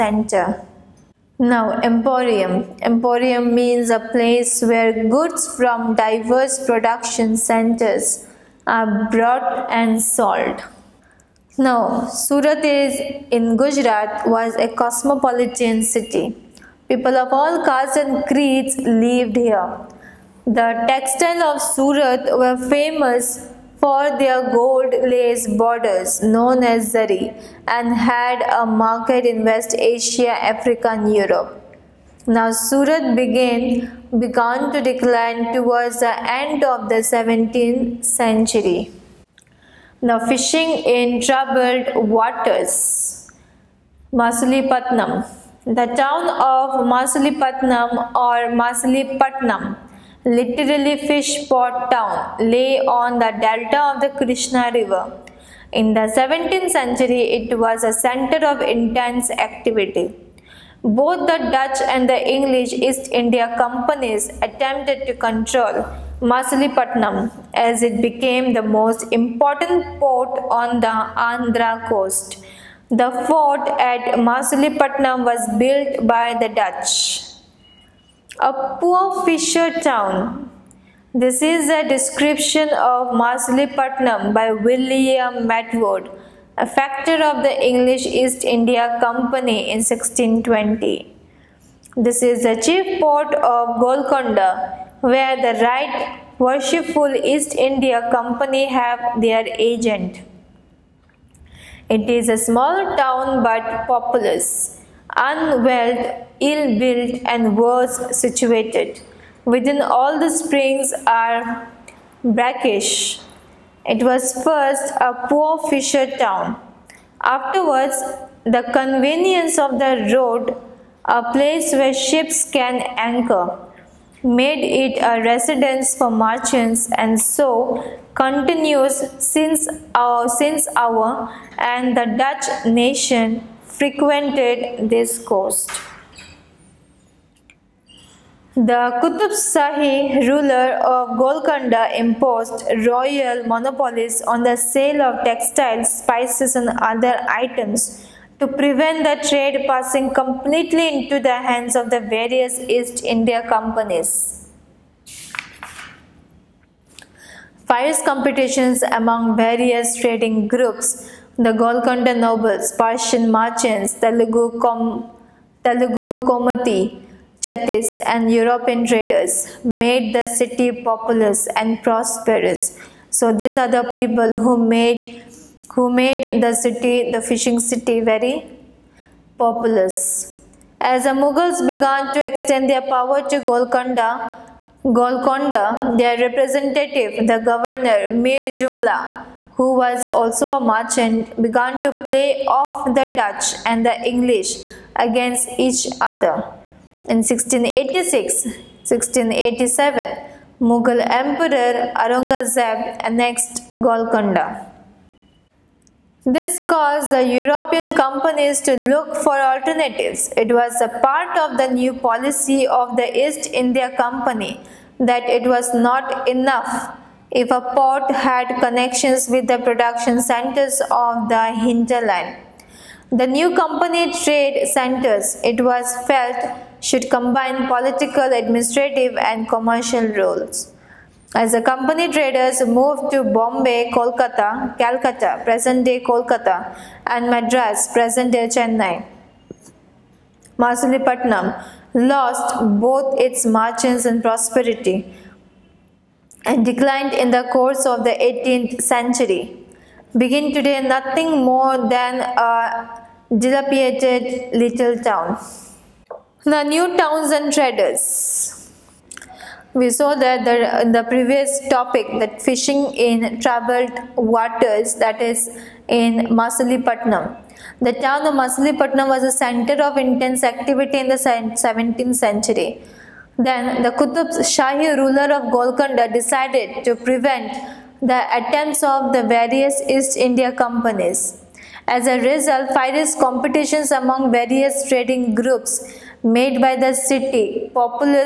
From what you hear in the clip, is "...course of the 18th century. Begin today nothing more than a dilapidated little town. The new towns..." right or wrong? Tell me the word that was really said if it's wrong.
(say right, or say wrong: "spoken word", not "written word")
right.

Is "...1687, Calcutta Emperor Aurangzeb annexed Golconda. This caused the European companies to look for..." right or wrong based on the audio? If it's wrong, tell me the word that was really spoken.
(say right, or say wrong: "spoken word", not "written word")
wrong: "Mughal", not "Calcutta".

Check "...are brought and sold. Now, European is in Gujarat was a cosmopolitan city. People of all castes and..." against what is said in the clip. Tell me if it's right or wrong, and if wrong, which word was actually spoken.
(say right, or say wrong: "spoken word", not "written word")
wrong: "Surat", not "European".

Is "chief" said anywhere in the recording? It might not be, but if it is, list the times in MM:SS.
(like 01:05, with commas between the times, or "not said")
01:32.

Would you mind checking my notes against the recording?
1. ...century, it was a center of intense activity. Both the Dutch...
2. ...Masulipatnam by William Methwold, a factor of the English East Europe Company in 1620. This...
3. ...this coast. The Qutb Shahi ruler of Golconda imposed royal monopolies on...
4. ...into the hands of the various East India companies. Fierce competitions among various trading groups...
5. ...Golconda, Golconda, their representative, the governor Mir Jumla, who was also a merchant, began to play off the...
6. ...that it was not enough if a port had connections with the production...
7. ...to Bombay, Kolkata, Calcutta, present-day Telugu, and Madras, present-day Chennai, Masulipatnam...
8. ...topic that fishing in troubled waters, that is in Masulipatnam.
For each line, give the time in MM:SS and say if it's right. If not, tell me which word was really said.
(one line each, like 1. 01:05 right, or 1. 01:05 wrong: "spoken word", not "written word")
1. 00:56 right
2. 01:23 wrong: "India", not "Europe"
3. 02:14 right
4. 02:30 right
5. 03:03 right
6. 03:34 right
7. 03:53 wrong: "Kolkata", not "Telugu"
8. 04:21 right.